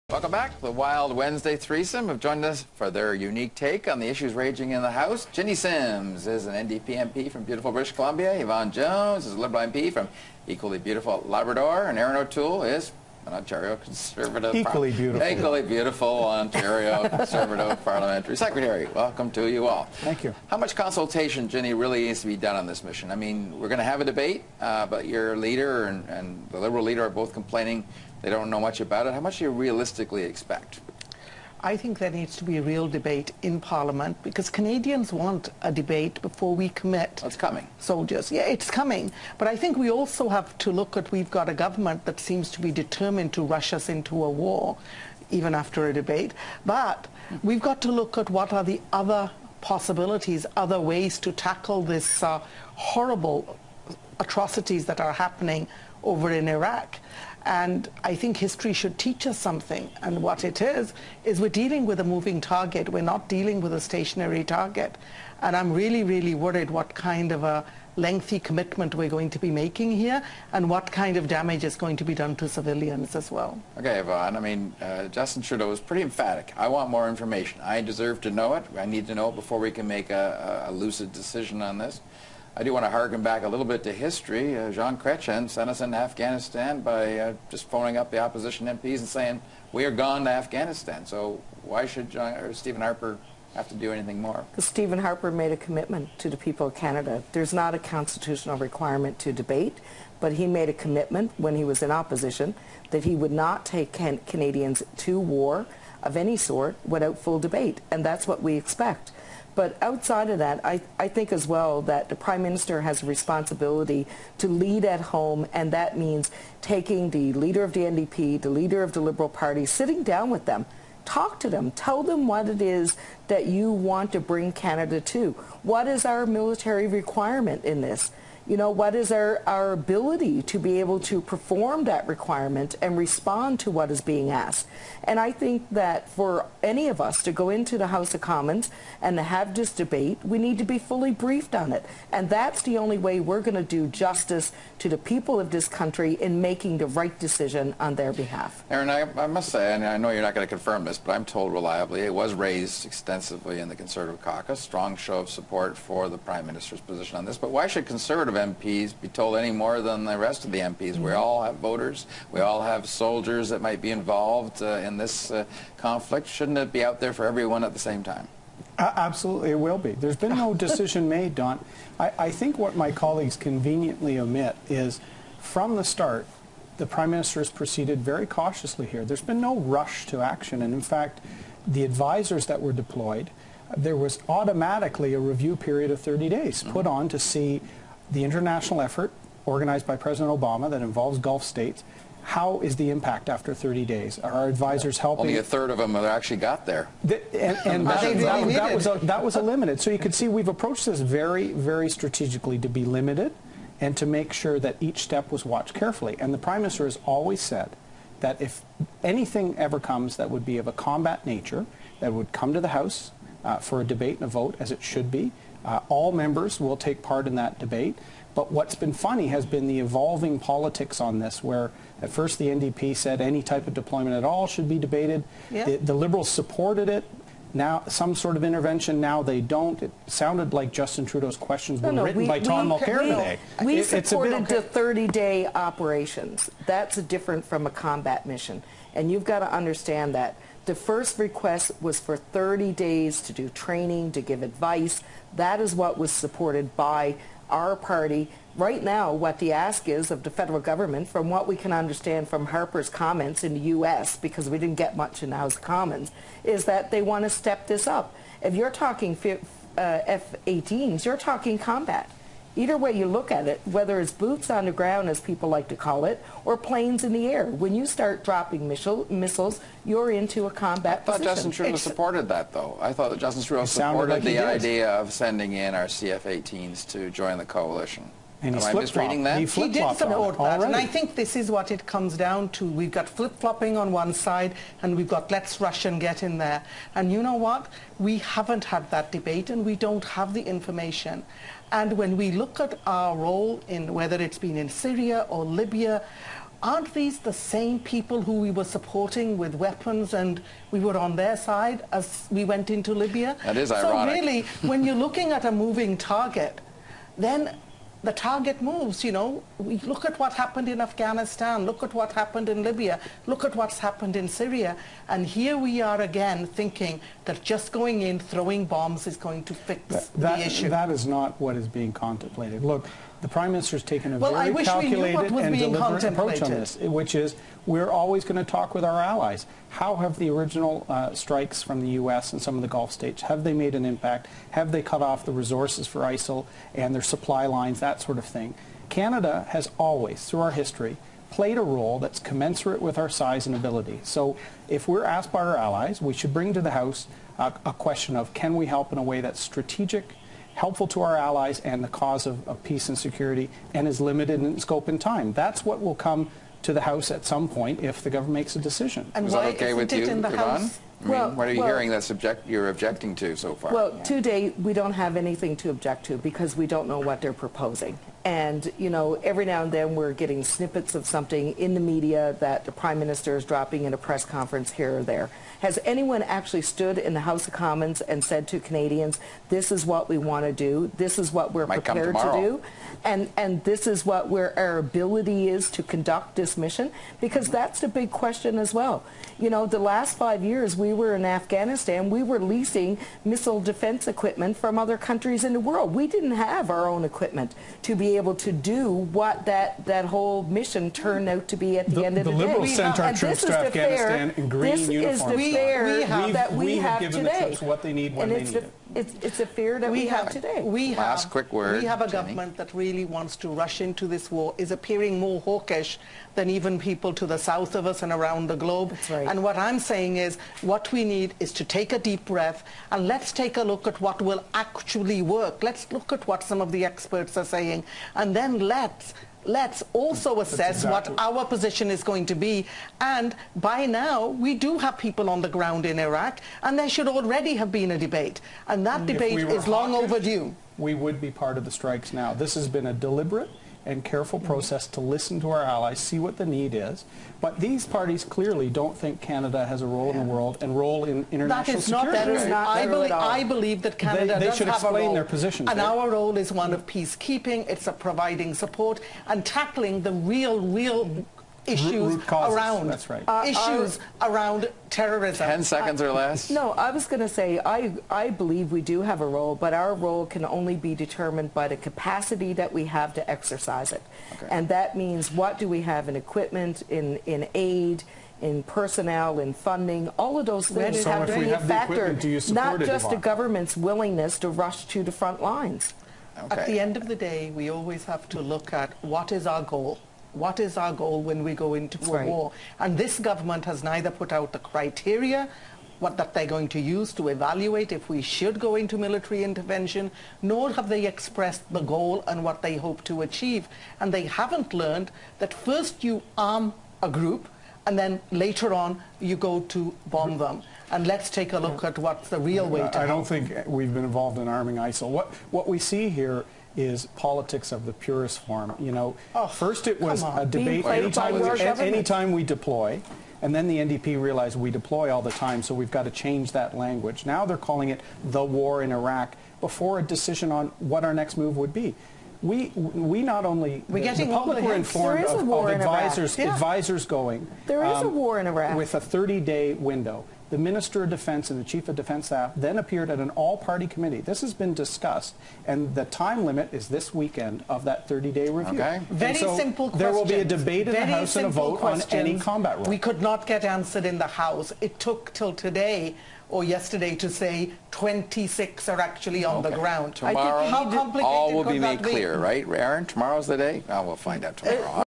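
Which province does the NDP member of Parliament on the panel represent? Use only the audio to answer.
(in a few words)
British Columbia.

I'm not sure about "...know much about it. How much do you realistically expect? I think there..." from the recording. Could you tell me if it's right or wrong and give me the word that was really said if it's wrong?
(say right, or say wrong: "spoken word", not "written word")
right.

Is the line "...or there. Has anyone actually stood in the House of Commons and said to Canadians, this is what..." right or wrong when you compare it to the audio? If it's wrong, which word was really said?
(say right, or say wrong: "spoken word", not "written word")
right.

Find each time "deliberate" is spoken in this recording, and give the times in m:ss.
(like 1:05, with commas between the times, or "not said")
5:25, 7:22.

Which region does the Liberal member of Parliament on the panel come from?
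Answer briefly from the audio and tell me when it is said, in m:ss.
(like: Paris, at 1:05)
Labrador, at 0:11.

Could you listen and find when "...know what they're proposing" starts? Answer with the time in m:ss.
6:06.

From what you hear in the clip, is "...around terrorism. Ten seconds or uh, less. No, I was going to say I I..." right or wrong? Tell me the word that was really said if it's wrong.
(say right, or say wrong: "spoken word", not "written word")
right.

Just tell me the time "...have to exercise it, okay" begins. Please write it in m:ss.
7:52.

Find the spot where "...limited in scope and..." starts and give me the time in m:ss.
5:53.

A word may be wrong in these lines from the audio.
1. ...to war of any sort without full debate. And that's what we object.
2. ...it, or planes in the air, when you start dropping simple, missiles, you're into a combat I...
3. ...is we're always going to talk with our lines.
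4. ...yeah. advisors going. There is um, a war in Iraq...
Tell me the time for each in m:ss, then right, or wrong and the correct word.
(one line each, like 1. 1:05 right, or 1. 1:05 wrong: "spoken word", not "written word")
1. 1:44 wrong: "expect", not "object"
2. 4:26 wrong: "missile", not "simple"
3. 5:27 wrong: "allies", not "lines"
4. 8:56 right.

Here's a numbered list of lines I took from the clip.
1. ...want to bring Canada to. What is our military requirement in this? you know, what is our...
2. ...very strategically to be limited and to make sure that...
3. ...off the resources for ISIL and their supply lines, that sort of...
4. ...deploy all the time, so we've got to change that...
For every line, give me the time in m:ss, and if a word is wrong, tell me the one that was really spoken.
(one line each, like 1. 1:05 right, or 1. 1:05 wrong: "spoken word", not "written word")
1. 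2:03 right
2. 3:21 right
3. 5:35 right
4. 8:44 right.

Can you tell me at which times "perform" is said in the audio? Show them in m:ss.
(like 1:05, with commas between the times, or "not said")
2:11.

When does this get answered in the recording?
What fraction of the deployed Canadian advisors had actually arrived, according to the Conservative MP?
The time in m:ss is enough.
3:15.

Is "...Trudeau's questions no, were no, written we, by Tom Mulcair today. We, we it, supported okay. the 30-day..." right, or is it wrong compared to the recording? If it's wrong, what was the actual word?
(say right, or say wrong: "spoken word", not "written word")
right.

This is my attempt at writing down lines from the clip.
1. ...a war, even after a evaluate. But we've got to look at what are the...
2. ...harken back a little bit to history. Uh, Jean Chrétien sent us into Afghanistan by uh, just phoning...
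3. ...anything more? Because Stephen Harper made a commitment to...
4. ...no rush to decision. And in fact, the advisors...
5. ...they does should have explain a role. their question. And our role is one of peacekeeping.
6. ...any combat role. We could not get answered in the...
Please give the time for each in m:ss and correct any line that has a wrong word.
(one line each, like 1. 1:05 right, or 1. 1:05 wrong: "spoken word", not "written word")
1. 0:44 wrong: "debate", not "evaluate"
2. 1:22 right
3. 1:33 right
4. 2:59 wrong: "action", not "decision"
5. 7:34 wrong: "position", not "question"
6. 9:12 right.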